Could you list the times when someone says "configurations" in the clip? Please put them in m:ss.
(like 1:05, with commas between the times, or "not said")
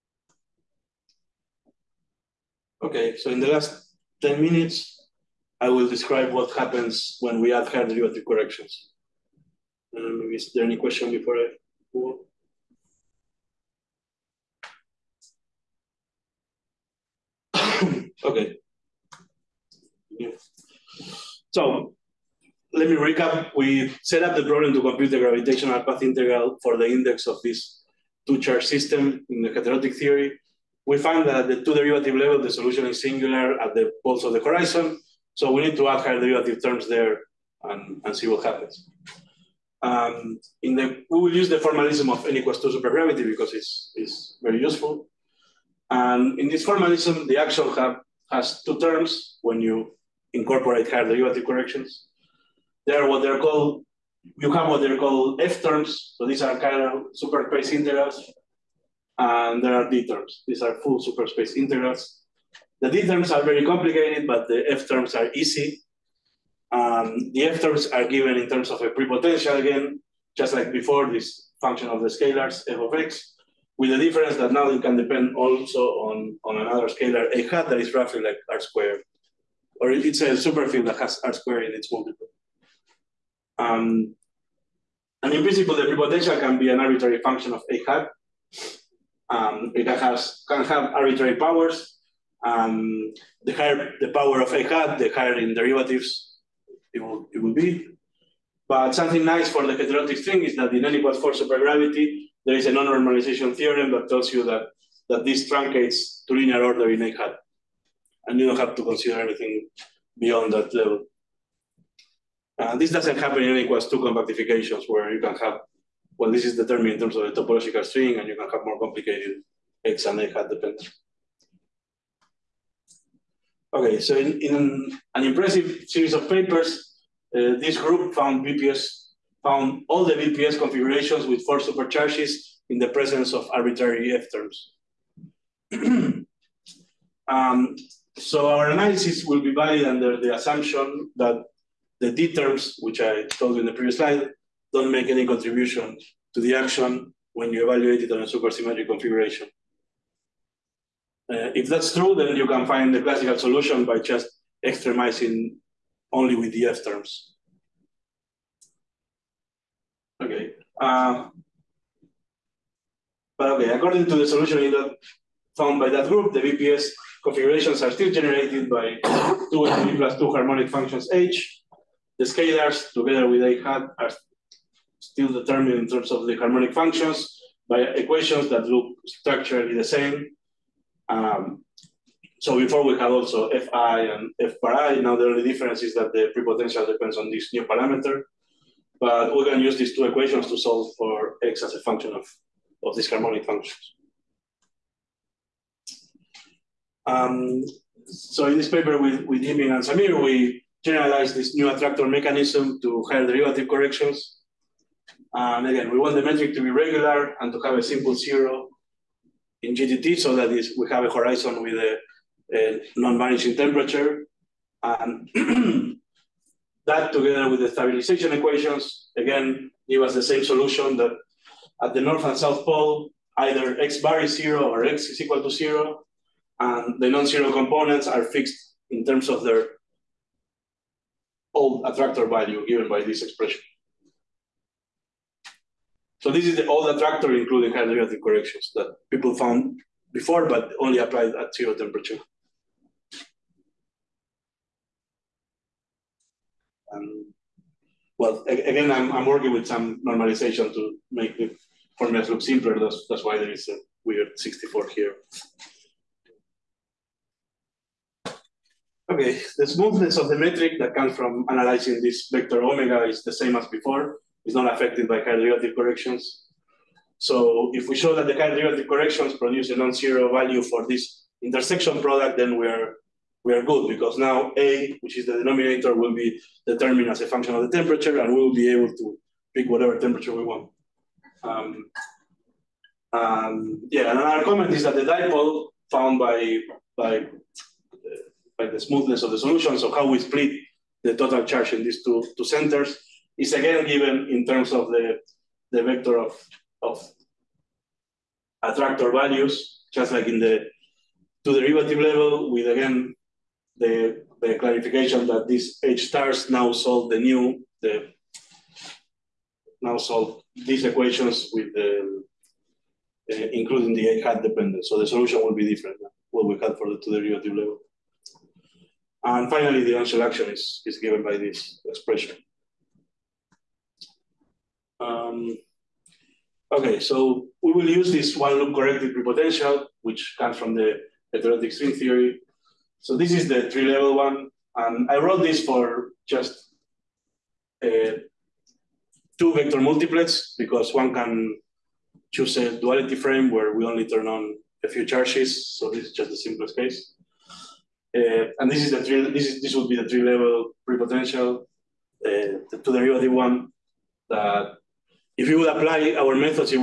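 2:10, 2:28, 2:47.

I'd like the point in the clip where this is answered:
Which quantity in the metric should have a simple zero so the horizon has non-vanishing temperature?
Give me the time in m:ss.
3:29.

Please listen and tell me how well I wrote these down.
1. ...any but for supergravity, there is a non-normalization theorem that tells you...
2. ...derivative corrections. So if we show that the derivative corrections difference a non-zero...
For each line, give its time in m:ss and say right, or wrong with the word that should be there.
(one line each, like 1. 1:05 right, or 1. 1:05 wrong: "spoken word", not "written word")
1. 1:40 right
2. 4:25 wrong: "produce", not "difference".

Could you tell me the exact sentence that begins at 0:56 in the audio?
So these are kind of superspace integrals.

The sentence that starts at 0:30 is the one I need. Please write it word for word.
We find that at the two derivative level, the solution is singular at the poles of the horizon.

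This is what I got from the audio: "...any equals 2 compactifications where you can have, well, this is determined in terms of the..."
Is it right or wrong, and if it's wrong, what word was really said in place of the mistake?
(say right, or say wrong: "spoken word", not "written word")
right.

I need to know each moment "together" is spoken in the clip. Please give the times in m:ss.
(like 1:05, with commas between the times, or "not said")
2:52, 3:37.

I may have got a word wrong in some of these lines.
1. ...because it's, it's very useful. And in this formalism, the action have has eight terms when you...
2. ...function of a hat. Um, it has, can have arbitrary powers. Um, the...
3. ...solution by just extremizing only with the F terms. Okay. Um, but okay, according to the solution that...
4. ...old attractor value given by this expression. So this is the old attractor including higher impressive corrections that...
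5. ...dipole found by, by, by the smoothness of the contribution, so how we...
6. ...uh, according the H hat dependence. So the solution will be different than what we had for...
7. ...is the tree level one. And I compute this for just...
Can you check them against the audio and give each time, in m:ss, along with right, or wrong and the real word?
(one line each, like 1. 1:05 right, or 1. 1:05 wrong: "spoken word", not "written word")
1. 0:43 wrong: "two", not "eight"
2. 1:27 right
3. 2:33 right
4. 3:51 wrong: "derivative", not "impressive"
5. 4:45 wrong: "solution", not "contribution"
6. 5:13 wrong: "including", not "according"
7. 5:33 wrong: "wrote", not "compute".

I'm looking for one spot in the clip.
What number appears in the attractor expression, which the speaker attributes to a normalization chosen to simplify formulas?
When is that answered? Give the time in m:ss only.
4:14.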